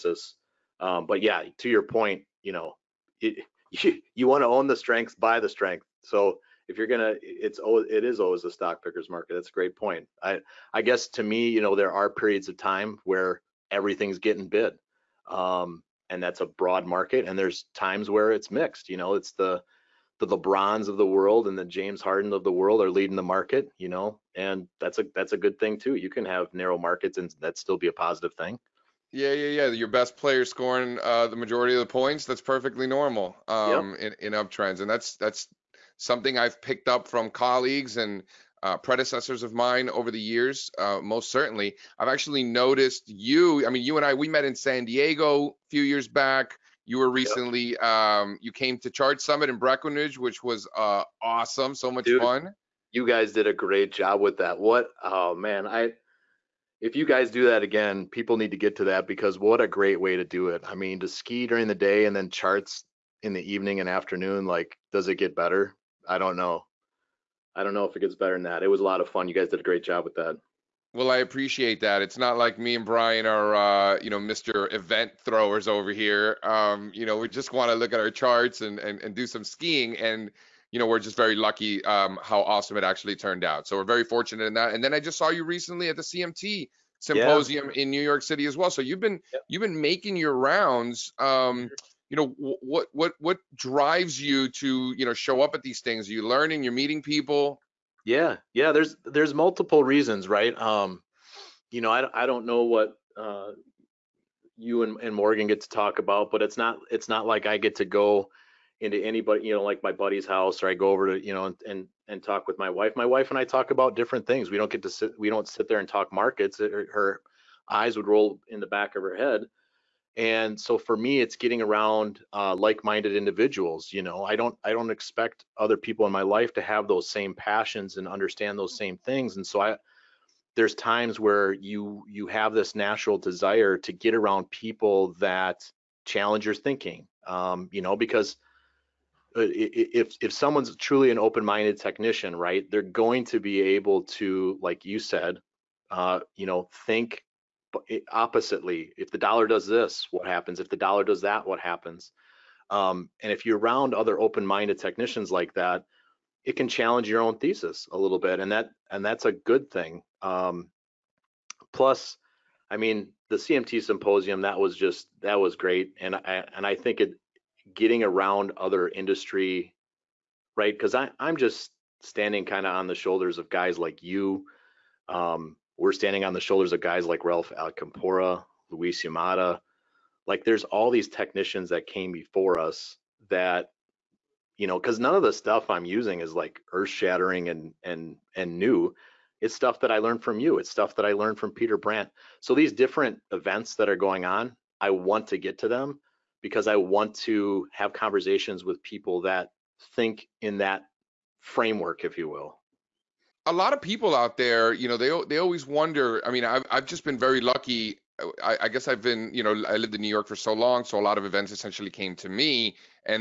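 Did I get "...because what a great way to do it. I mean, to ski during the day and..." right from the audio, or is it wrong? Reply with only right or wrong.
right.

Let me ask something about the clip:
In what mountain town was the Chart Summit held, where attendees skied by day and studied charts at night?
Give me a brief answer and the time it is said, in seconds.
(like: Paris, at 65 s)
Breckenridge, at 49 s.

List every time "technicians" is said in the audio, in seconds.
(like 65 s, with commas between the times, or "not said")
141 s, 154 s, 181 s.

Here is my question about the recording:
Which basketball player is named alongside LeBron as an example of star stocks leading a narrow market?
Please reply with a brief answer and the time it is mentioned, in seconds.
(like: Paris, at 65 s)
James Harden, at 21 s.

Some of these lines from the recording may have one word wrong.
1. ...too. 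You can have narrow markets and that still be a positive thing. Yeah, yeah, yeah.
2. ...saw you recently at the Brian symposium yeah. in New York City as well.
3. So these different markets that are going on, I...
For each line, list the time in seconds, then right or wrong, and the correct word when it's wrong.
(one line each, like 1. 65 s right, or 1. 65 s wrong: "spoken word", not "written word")
1. 25 s right
2. 85 s wrong: "CMT", not "Brian"
3. 192 s wrong: "events", not "markets".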